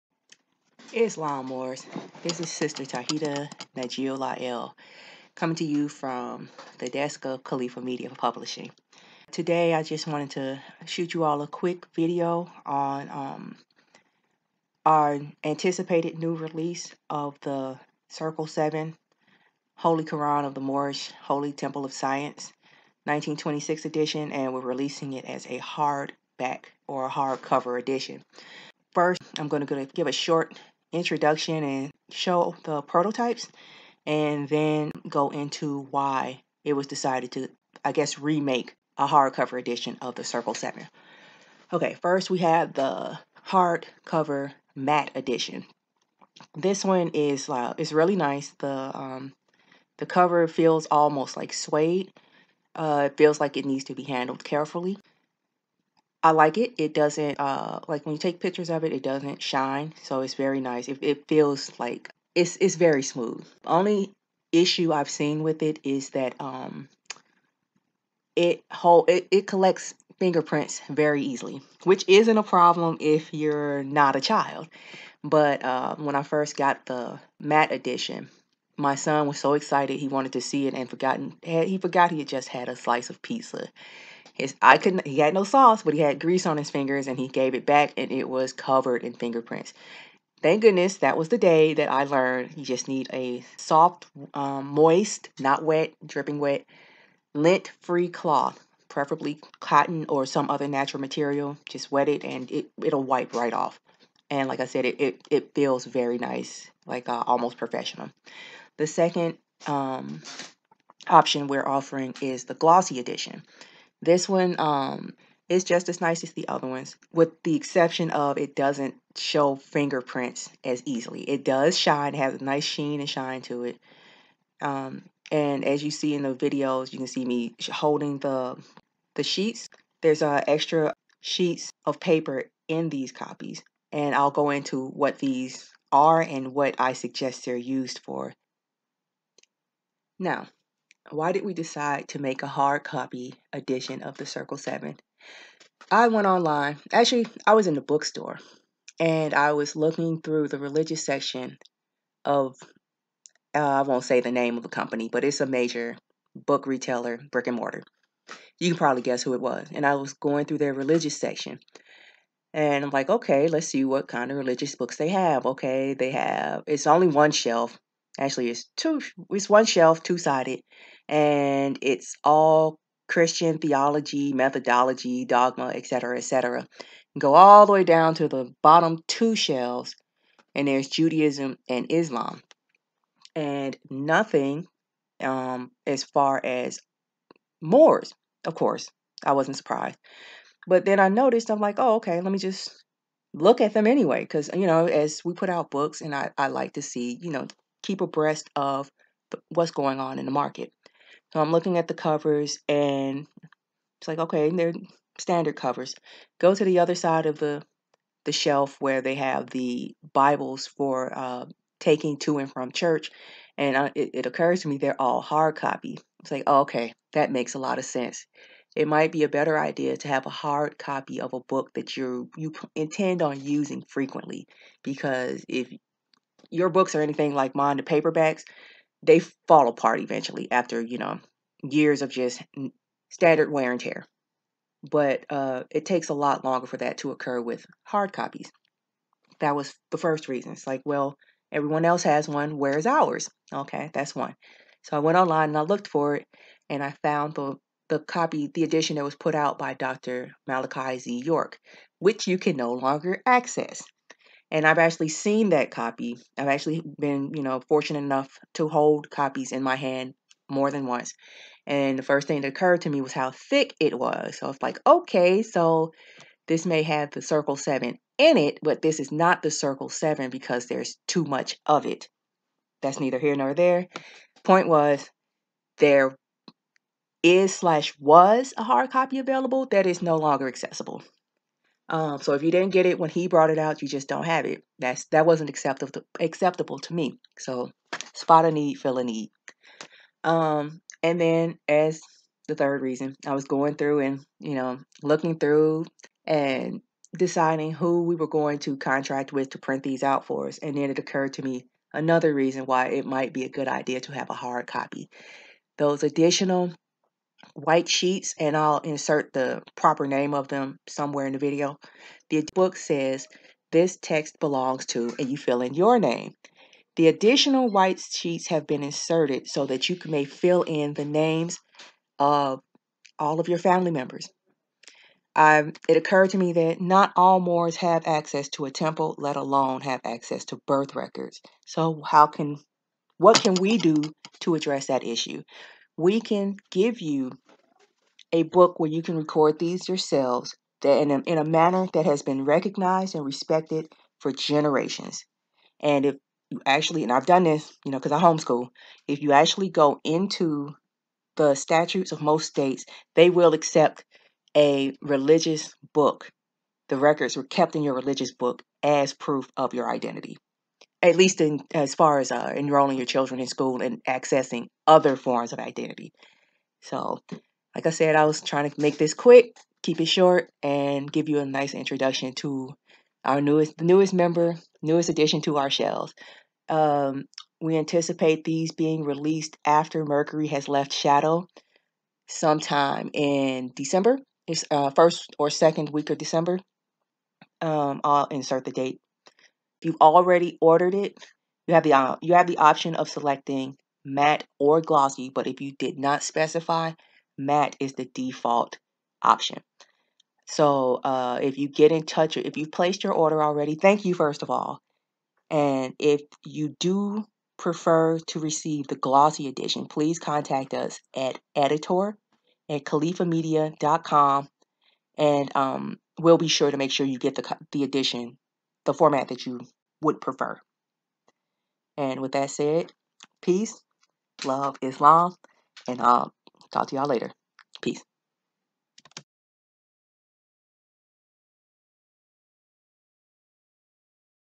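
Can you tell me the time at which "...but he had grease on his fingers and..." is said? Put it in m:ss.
1:25.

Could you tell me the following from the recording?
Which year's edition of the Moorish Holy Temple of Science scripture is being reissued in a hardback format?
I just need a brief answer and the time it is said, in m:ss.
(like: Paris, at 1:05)
1926, at 0:23.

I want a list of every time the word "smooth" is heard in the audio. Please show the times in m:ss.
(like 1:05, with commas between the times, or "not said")
1:03.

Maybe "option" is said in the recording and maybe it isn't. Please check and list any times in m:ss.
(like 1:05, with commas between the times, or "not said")
1:51, 6:32, 6:39.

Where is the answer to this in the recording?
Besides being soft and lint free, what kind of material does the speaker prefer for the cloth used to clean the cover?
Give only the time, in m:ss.
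1:39.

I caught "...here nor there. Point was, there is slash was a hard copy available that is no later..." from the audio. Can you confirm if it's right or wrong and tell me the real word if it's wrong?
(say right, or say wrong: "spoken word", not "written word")
wrong: "longer", not "later".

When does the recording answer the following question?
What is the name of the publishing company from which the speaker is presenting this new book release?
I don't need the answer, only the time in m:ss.
0:07.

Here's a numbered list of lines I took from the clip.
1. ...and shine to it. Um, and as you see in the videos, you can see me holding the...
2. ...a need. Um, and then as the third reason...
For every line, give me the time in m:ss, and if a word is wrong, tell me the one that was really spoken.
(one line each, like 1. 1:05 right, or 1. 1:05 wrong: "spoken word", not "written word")
1. 2:03 right
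2. 4:48 right.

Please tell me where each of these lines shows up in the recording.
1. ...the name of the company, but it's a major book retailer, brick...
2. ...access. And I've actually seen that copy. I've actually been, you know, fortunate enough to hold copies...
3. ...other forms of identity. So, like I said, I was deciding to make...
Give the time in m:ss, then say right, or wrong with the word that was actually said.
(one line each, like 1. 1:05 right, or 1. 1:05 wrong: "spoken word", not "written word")
1. 2:34 right
2. 4:13 right
3. 6:04 wrong: "trying", not "deciding".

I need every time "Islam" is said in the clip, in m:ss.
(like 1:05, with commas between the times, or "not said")
0:00, 3:01, 7:04.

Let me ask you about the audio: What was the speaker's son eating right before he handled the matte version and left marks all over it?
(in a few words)
Pizza.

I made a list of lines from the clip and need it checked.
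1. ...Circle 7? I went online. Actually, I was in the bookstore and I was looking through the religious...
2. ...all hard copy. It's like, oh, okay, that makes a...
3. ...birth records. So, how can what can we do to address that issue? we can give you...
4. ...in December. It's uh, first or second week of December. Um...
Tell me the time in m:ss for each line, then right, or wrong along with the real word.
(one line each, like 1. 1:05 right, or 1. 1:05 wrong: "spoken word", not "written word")
1. 2:24 right
2. 3:35 right
3. 5:30 right
4. 6:23 right.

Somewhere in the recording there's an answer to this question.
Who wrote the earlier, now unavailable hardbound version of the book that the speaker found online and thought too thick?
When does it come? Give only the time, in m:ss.
4:09.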